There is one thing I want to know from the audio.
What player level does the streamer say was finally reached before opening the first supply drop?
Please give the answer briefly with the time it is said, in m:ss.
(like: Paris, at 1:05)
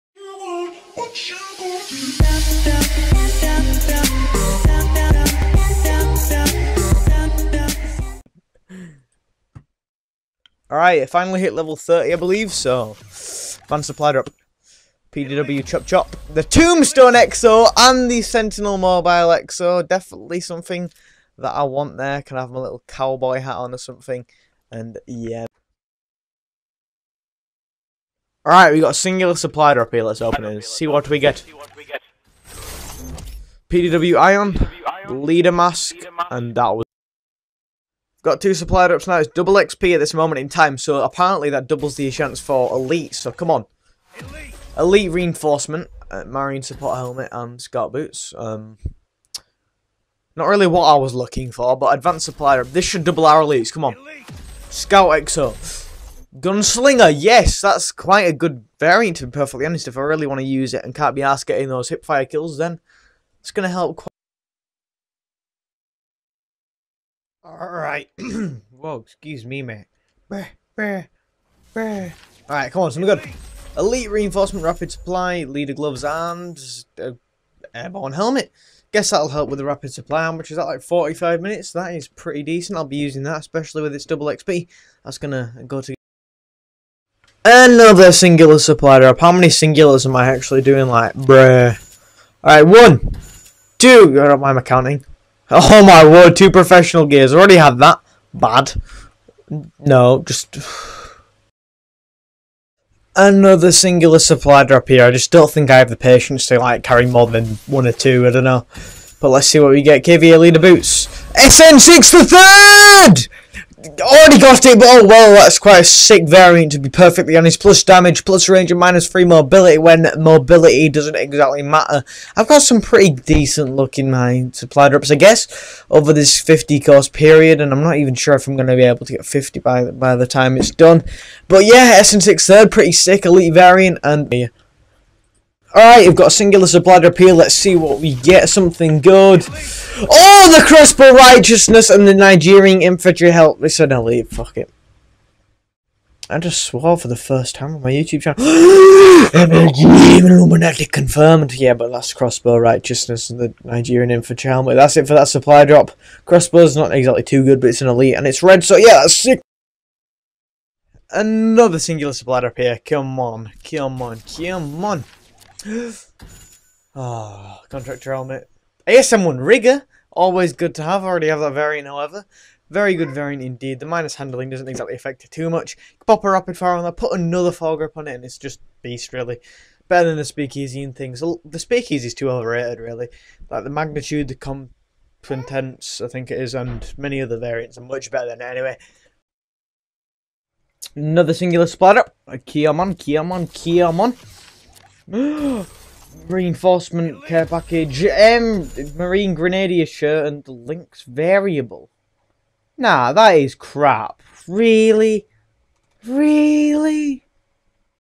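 30, at 0:11.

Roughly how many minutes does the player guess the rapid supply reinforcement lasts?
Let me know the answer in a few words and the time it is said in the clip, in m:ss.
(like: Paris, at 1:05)
45 minutes, at 1:20.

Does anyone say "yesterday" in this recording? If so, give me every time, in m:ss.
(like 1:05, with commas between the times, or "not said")
not said.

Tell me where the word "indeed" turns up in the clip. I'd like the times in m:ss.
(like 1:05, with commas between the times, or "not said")
2:53.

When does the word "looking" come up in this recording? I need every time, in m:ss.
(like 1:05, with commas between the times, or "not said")
0:51.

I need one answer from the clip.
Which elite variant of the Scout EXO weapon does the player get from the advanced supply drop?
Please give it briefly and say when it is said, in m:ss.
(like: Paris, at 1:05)
Gunslinger, at 0:56.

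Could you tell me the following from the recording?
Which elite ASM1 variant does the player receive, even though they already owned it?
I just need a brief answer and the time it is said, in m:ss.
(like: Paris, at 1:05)
Rigger, at 2:49.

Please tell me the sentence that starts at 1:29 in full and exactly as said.
How many singulars am I actually doing?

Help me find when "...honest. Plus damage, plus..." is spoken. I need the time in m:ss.
1:57.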